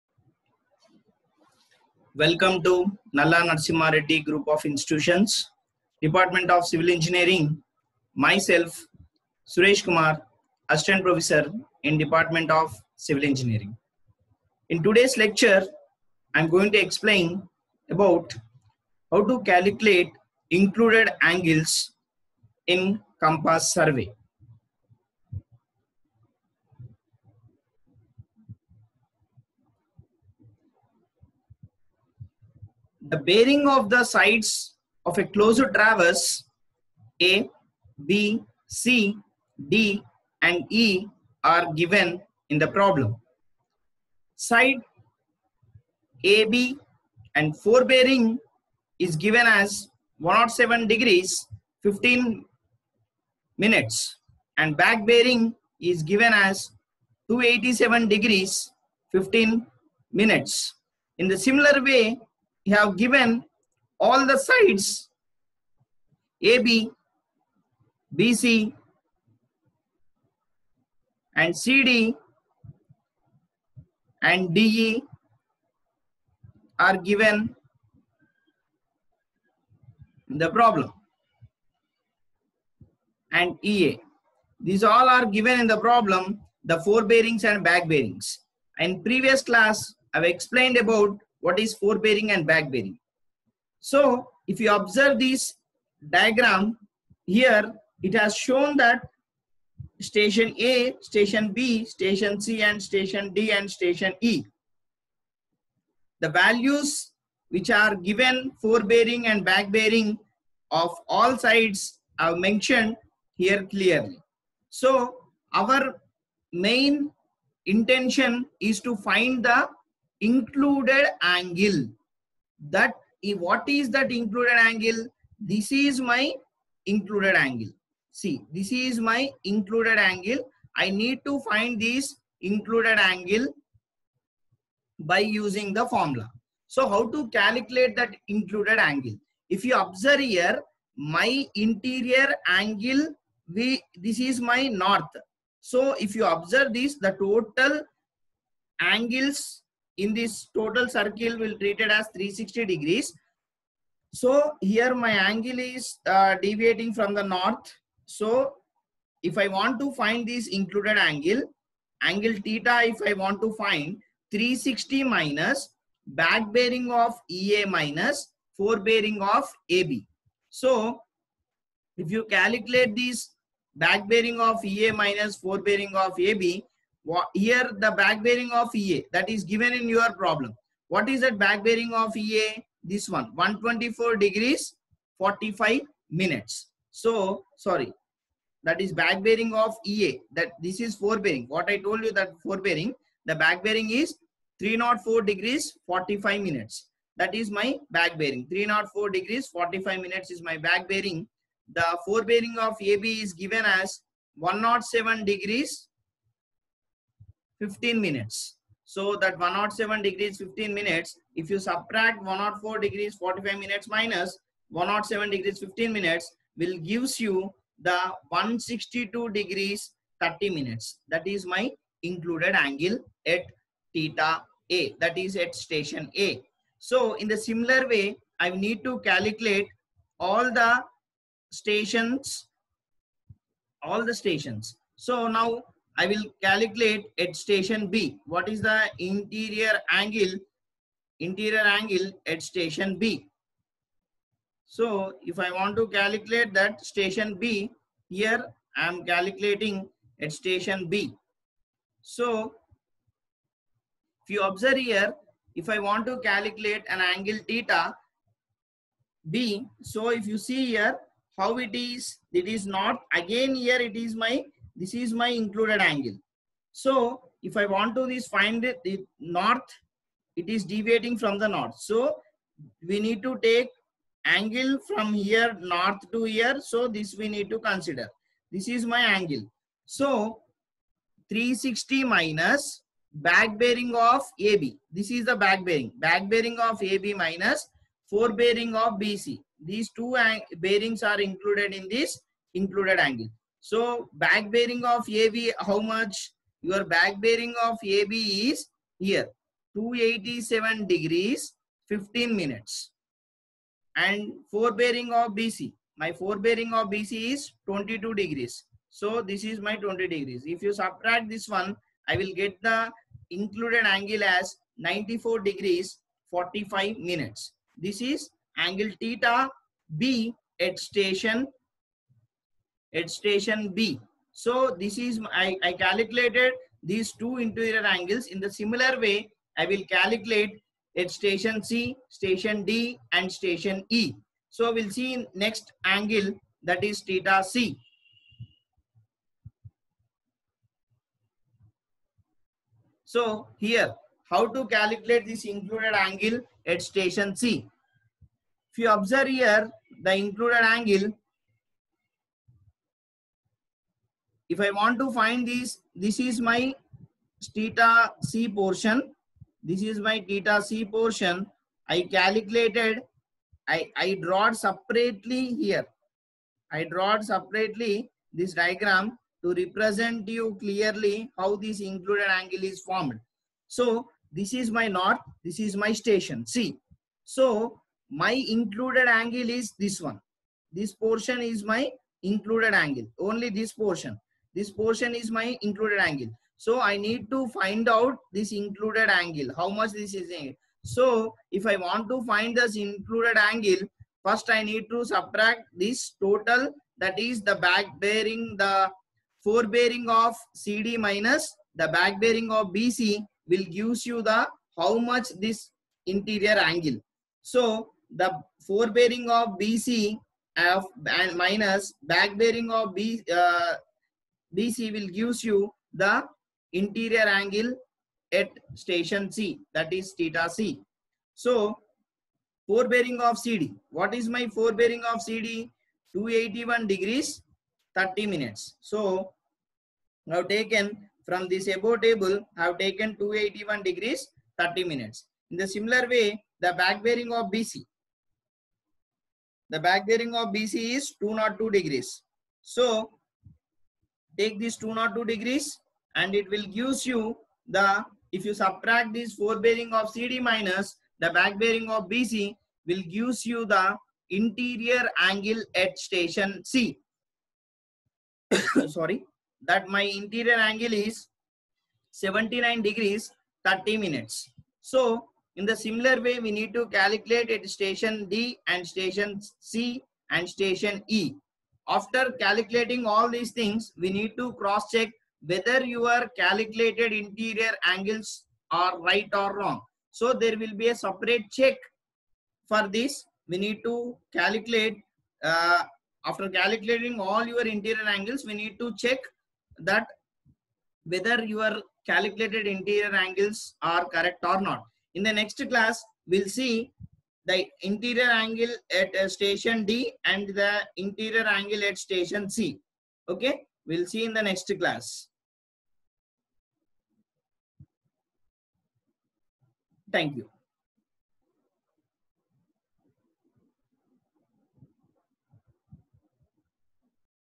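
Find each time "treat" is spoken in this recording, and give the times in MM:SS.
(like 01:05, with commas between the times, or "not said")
02:31.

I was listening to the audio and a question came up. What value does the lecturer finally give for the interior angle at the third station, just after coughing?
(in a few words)
79 degrees 30 minutes.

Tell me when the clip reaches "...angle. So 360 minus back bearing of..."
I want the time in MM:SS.
04:39.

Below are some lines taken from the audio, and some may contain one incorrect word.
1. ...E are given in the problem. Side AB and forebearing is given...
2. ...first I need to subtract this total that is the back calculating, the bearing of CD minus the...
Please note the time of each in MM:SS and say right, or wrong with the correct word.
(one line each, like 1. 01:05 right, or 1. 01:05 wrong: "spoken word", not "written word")
1. 00:40 right
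2. 06:34 wrong: "bearing", not "calculating".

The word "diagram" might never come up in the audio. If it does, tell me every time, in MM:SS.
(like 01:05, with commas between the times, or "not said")
01:36, 06:08.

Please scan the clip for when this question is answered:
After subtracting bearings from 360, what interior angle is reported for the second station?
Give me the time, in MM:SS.
05:14.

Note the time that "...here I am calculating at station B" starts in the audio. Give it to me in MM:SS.
04:08.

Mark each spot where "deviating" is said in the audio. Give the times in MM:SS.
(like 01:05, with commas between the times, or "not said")
02:36, 04:30.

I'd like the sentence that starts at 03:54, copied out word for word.
So now I will calculate at station B.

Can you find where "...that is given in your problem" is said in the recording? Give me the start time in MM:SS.
02:59.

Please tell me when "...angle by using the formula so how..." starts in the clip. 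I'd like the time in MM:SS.
02:12.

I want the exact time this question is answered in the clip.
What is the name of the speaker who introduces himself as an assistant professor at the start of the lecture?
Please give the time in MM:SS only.
00:09.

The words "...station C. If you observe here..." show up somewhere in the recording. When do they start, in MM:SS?
05:46.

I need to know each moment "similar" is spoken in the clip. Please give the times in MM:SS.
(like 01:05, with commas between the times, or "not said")
01:01, 03:47, 05:28, 07:15, 07:45.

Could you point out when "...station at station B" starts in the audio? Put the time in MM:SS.
05:20.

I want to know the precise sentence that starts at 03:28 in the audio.
So that 107 degrees 15 minutes.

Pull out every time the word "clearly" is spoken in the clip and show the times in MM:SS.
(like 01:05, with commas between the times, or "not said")
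01:53, 06:10.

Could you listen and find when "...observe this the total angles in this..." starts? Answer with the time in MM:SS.
02:26.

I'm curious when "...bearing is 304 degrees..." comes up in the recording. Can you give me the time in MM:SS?
03:13.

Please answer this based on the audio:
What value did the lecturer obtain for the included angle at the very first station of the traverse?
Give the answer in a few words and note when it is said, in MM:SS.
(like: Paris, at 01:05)
162 degrees 30 minutes, at 03:38.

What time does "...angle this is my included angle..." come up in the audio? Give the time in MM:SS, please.
02:04.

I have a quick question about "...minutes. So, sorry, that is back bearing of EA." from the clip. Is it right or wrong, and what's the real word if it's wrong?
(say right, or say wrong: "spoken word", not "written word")
right.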